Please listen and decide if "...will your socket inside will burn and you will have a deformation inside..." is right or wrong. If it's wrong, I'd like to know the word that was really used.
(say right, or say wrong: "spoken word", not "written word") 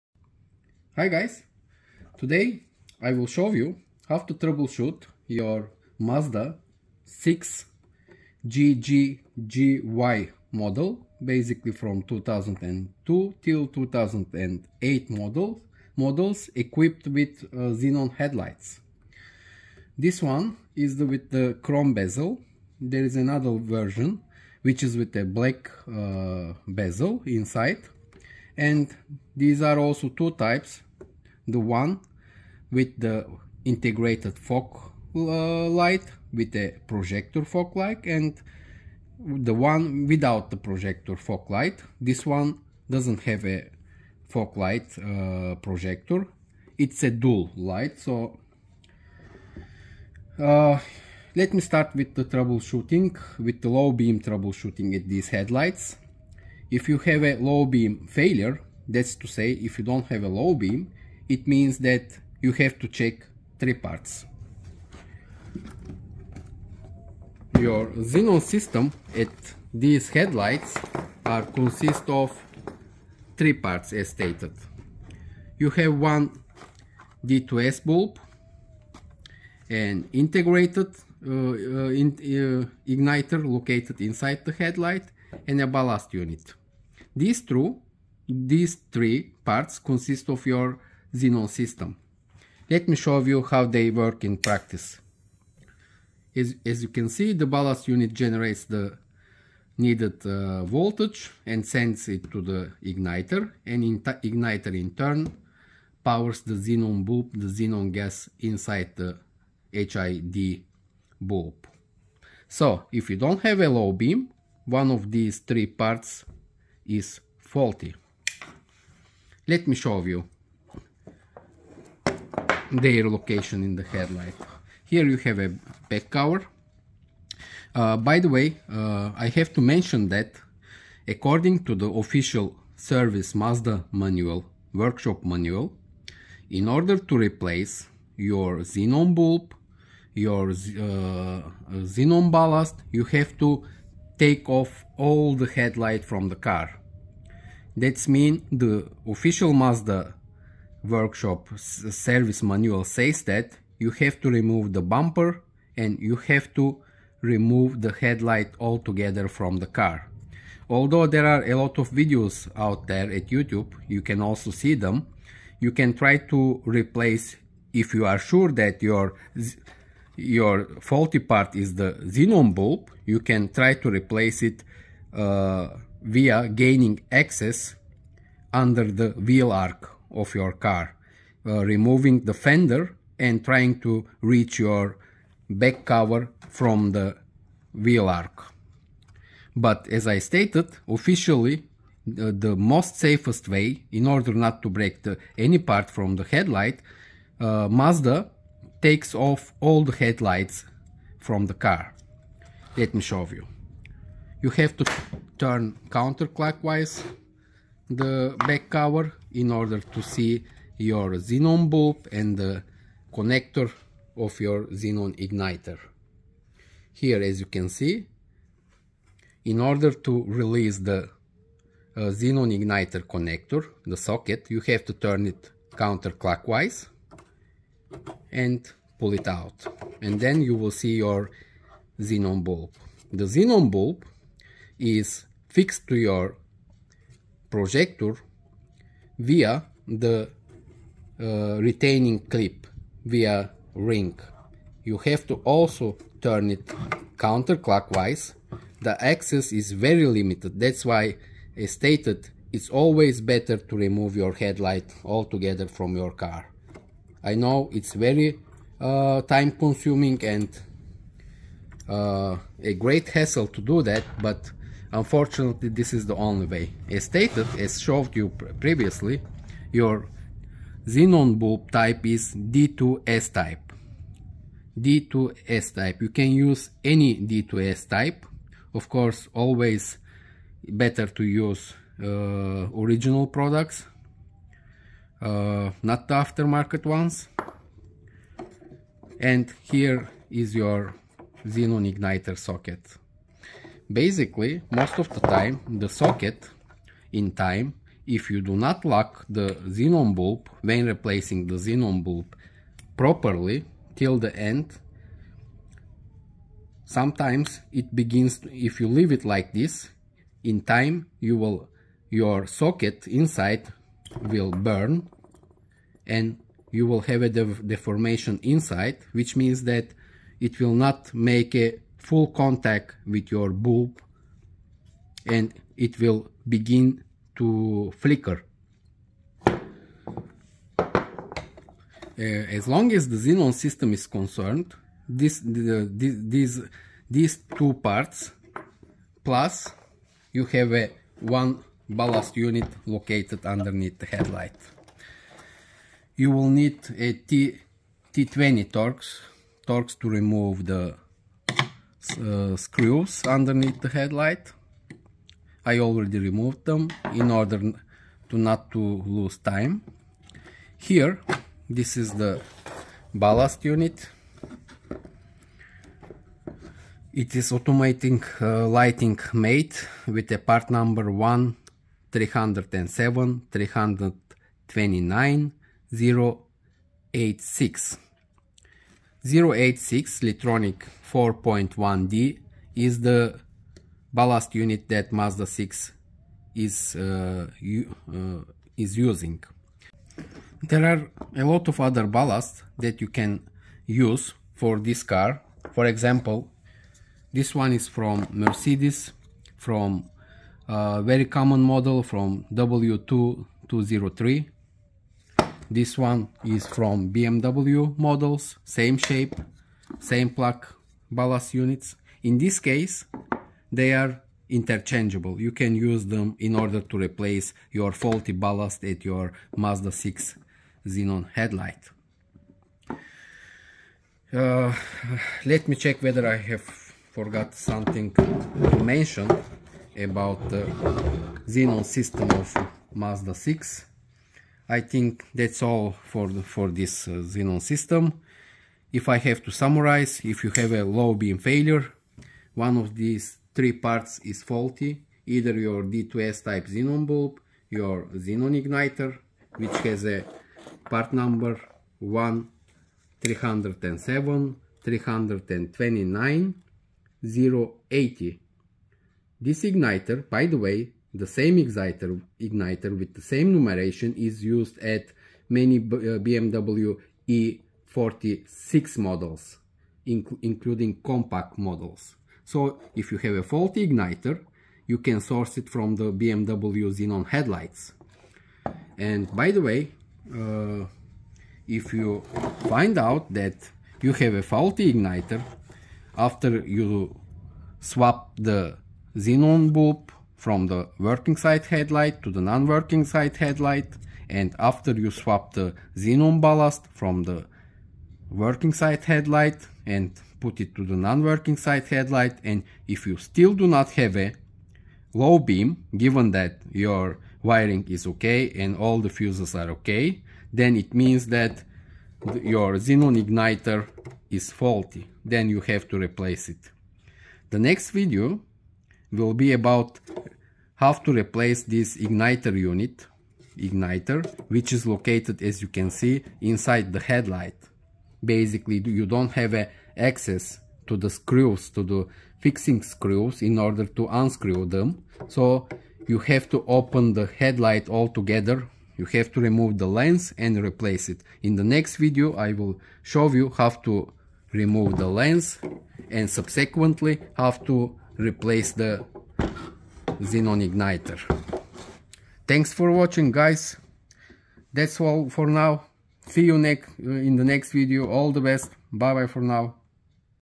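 right.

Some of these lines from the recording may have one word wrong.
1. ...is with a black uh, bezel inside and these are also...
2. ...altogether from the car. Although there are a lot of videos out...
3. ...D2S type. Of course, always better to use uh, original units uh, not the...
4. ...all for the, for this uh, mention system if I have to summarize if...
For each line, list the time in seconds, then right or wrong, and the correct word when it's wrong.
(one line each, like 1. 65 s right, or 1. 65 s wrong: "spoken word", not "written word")
1. 24 s right
2. 158 s right
3. 277 s wrong: "products", not "units"
4. 435 s wrong: "xenon", not "mention".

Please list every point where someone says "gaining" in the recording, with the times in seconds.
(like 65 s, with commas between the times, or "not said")
176 s.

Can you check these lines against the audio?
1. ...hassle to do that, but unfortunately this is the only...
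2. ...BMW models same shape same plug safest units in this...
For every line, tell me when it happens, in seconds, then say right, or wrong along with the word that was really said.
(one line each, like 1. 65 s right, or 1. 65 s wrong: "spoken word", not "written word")
1. 263 s right
2. 407 s wrong: "ballast", not "safest".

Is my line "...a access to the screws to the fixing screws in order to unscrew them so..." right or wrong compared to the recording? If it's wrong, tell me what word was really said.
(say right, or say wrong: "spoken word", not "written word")
right.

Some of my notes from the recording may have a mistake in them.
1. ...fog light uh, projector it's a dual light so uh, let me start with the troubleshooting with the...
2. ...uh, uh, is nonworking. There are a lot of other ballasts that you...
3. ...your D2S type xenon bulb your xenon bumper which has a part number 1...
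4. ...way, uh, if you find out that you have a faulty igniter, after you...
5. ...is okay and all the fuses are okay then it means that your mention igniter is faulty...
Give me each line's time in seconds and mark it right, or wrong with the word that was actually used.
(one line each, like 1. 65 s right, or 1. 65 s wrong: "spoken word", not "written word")
1. 44 s right
2. 386 s wrong: "using", not "nonworking"
3. 445 s wrong: "igniter", not "bumper"
4. 479 s right
5. 507 s wrong: "xenon", not "mention".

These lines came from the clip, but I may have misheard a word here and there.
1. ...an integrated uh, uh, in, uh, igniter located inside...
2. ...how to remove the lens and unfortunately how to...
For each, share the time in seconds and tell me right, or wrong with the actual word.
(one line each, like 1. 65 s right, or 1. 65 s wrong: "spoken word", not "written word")
1. 79 s right
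2. 543 s wrong: "subsequently", not "unfortunately".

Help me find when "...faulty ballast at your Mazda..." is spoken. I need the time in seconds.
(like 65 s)
417 s.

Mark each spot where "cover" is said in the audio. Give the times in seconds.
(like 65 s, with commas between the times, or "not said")
126 s, 185 s, 208 s.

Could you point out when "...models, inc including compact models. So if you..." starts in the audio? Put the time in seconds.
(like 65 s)
468 s.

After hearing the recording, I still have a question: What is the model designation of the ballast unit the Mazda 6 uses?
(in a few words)
Litronic 4.1D.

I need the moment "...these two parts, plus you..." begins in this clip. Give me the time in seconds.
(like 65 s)
337 s.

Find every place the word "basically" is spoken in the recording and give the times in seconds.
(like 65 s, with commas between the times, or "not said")
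11 s, 293 s, 528 s.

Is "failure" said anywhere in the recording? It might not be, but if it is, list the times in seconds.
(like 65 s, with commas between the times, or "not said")
58 s, 441 s.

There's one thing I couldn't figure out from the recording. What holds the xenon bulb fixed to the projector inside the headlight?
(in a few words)
Retaining clip.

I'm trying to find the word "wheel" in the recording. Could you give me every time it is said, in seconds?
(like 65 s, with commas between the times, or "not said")
179 s, 187 s.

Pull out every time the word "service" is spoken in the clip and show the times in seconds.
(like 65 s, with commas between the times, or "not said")
132 s, 151 s.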